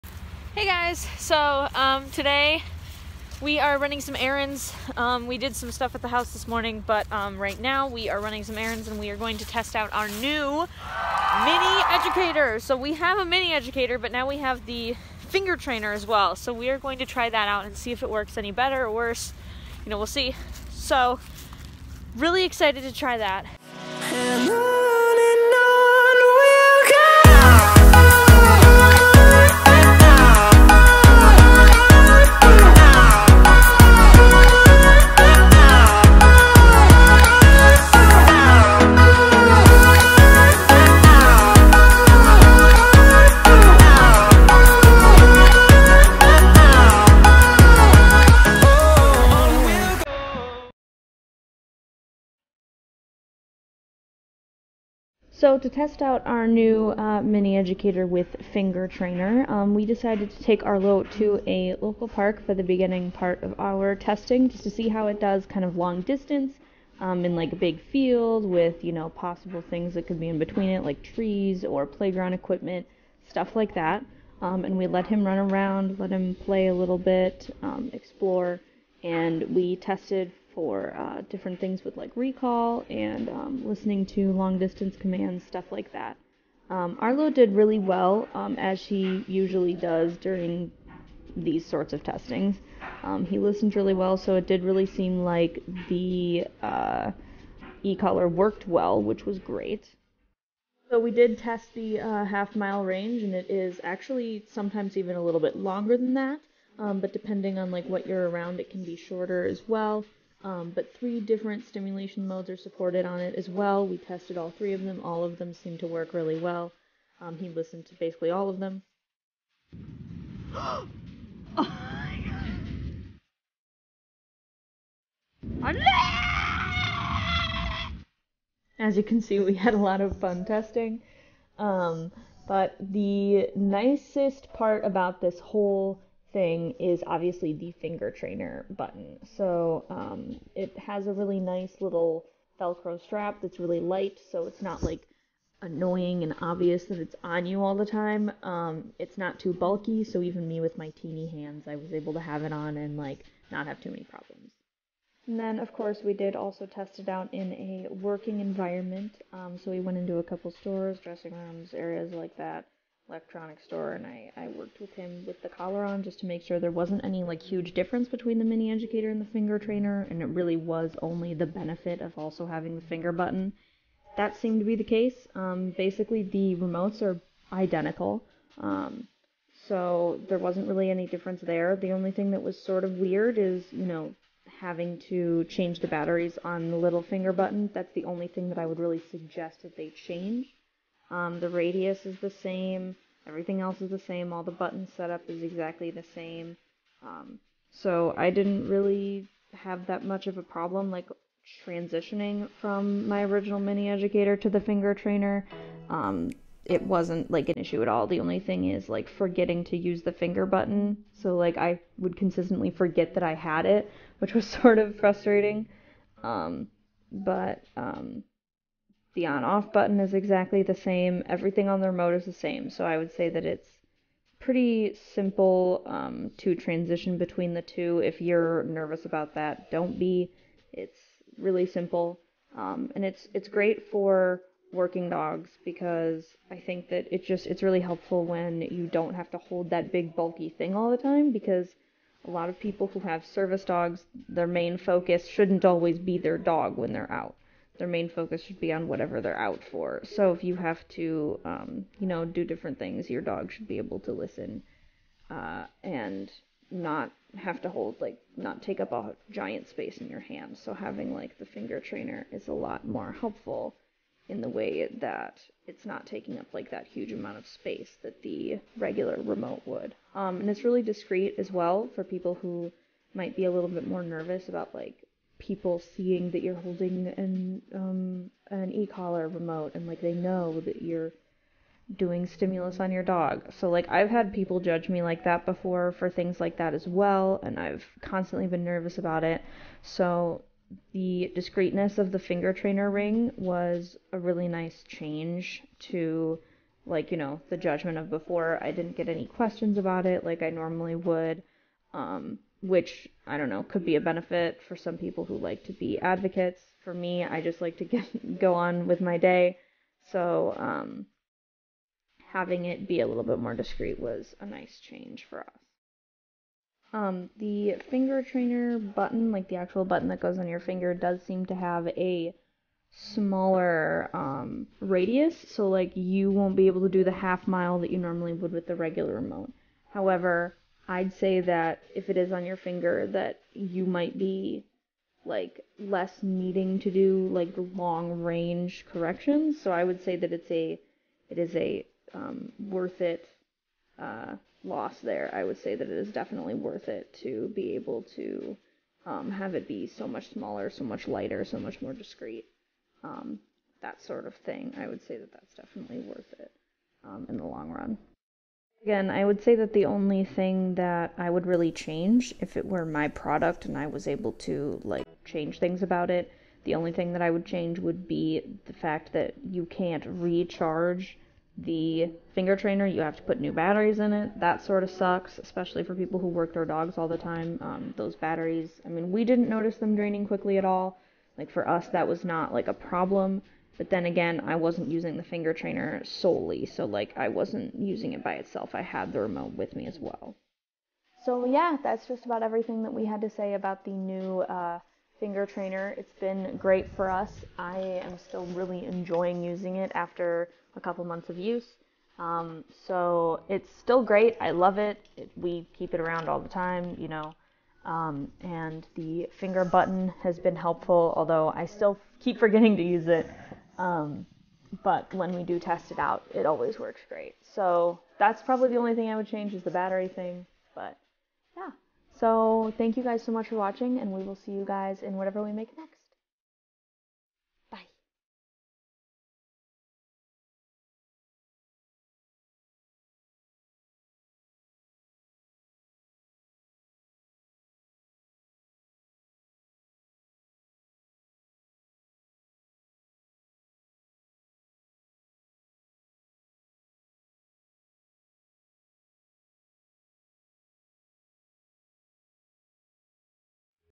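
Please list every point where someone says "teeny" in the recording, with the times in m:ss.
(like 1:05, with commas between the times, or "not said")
2:30.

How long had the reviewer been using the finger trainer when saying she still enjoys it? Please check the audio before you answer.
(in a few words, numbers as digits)
A couple months.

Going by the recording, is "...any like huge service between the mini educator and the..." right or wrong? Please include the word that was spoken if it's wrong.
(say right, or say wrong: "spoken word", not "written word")
wrong: "difference", not "service".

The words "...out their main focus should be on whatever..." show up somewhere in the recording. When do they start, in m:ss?
4:07.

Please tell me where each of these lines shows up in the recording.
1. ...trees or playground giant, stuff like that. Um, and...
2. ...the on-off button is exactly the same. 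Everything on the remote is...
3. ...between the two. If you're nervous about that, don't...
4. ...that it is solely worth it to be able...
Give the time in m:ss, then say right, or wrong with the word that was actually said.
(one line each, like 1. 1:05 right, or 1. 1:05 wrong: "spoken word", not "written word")
1. 1:11 wrong: "equipment", not "giant"
2. 3:39 right
3. 3:47 right
4. 5:45 wrong: "definitely", not "solely".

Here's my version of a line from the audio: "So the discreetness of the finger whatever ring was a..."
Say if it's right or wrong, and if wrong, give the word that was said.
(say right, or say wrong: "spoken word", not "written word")
wrong: "trainer", not "whatever".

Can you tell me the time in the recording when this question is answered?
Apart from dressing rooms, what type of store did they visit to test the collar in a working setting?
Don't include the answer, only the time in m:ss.
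2:43.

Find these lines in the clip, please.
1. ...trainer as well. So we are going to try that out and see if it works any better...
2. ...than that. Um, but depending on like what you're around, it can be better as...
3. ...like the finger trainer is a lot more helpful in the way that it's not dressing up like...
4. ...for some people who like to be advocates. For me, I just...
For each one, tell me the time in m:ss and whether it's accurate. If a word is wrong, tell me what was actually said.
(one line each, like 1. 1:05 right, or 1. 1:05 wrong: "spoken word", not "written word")
1. 0:15 right
2. 1:45 wrong: "shorter", not "better"
3. 4:21 wrong: "taking", not "dressing"
4. 5:04 right.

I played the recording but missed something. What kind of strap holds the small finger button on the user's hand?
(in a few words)
Velcro strap.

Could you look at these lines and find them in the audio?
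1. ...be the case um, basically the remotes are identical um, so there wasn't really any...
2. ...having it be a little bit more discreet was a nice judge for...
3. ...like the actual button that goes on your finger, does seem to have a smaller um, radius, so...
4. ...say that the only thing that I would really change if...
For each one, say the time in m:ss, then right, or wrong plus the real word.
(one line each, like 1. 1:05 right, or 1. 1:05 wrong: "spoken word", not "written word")
1. 2:54 right
2. 5:12 wrong: "change", not "judge"
3. 5:19 right
4. 5:59 right.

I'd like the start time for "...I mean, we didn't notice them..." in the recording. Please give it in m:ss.
6:18.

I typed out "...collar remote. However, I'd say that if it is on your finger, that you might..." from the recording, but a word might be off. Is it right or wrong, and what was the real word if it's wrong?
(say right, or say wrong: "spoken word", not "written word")
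wrong: "regular", not "collar".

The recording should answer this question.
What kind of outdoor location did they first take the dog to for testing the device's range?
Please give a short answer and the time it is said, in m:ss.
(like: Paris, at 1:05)
A local park, at 1:01.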